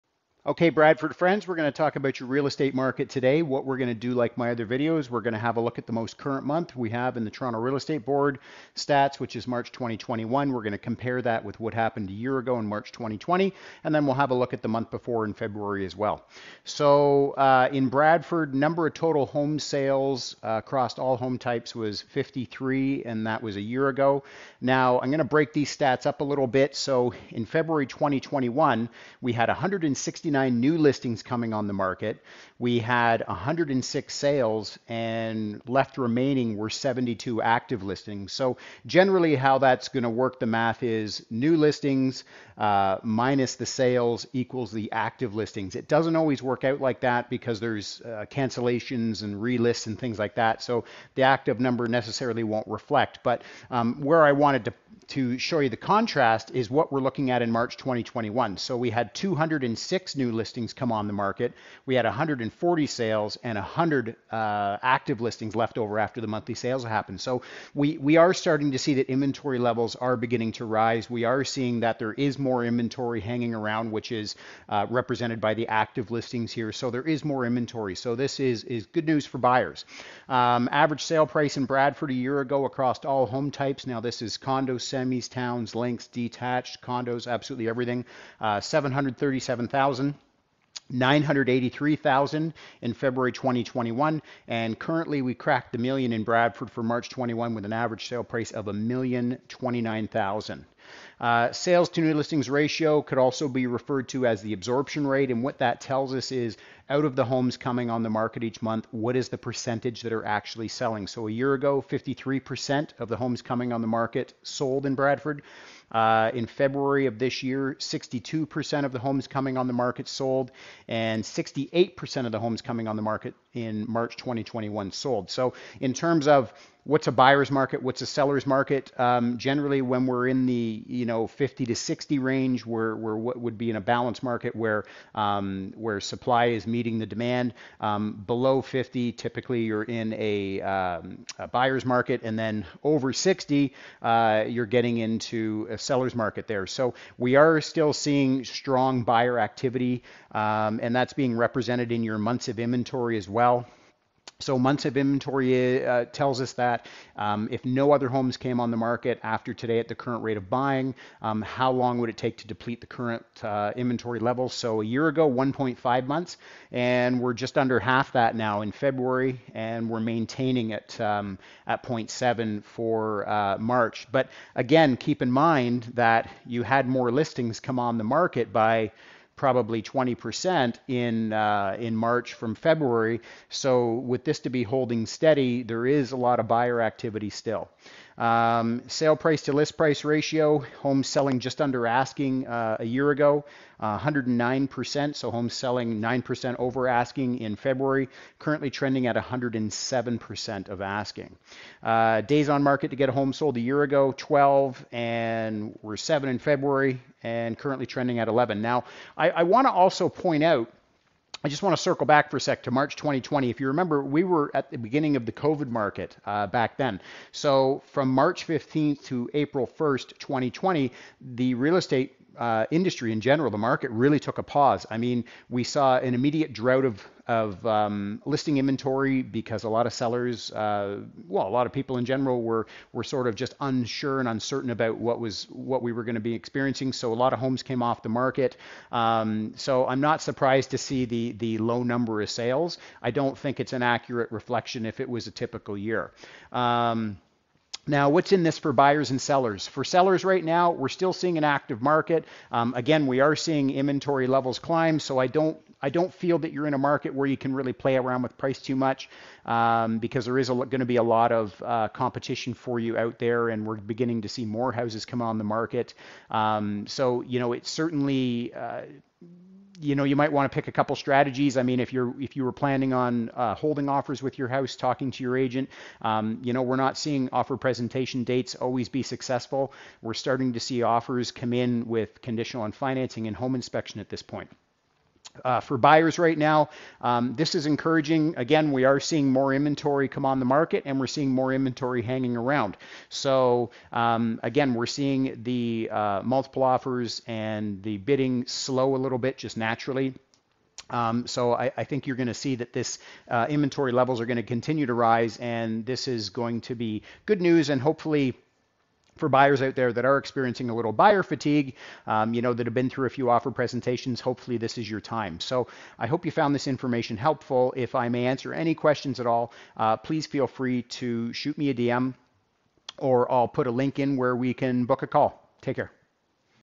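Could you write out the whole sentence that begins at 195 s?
So homes selling 9% over asking in February, currently trending at 107% of asking.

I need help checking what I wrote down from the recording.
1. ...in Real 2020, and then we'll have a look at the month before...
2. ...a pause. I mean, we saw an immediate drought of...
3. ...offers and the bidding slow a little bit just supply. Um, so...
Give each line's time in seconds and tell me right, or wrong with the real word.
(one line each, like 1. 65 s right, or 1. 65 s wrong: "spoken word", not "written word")
1. 12 s wrong: "March", not "Real"
2. 224 s right
3. 296 s wrong: "naturally", not "supply".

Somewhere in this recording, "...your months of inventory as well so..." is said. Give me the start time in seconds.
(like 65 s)
152 s.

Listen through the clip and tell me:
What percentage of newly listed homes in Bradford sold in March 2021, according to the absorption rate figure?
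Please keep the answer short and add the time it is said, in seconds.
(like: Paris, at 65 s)
68%, at 121 s.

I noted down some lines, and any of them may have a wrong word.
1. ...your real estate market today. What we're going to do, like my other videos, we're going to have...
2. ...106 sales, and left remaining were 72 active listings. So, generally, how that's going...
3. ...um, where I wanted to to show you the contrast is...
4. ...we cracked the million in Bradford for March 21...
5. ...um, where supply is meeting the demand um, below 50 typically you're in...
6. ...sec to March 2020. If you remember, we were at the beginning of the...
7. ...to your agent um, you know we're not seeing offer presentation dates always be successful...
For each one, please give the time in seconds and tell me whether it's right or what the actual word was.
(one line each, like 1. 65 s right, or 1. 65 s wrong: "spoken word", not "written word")
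1. 2 s right
2. 33 s right
3. 53 s right
4. 95 s right
5. 135 s right
6. 212 s right
7. 275 s right.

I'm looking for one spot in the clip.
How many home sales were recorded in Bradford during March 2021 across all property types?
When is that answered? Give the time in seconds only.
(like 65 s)
62 s.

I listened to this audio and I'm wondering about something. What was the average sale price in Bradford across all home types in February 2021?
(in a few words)
$983,000.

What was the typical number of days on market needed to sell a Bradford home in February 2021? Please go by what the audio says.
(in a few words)
7.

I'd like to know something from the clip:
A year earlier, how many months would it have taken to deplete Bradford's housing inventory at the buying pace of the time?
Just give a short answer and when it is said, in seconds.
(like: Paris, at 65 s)
1.5 months, at 165 s.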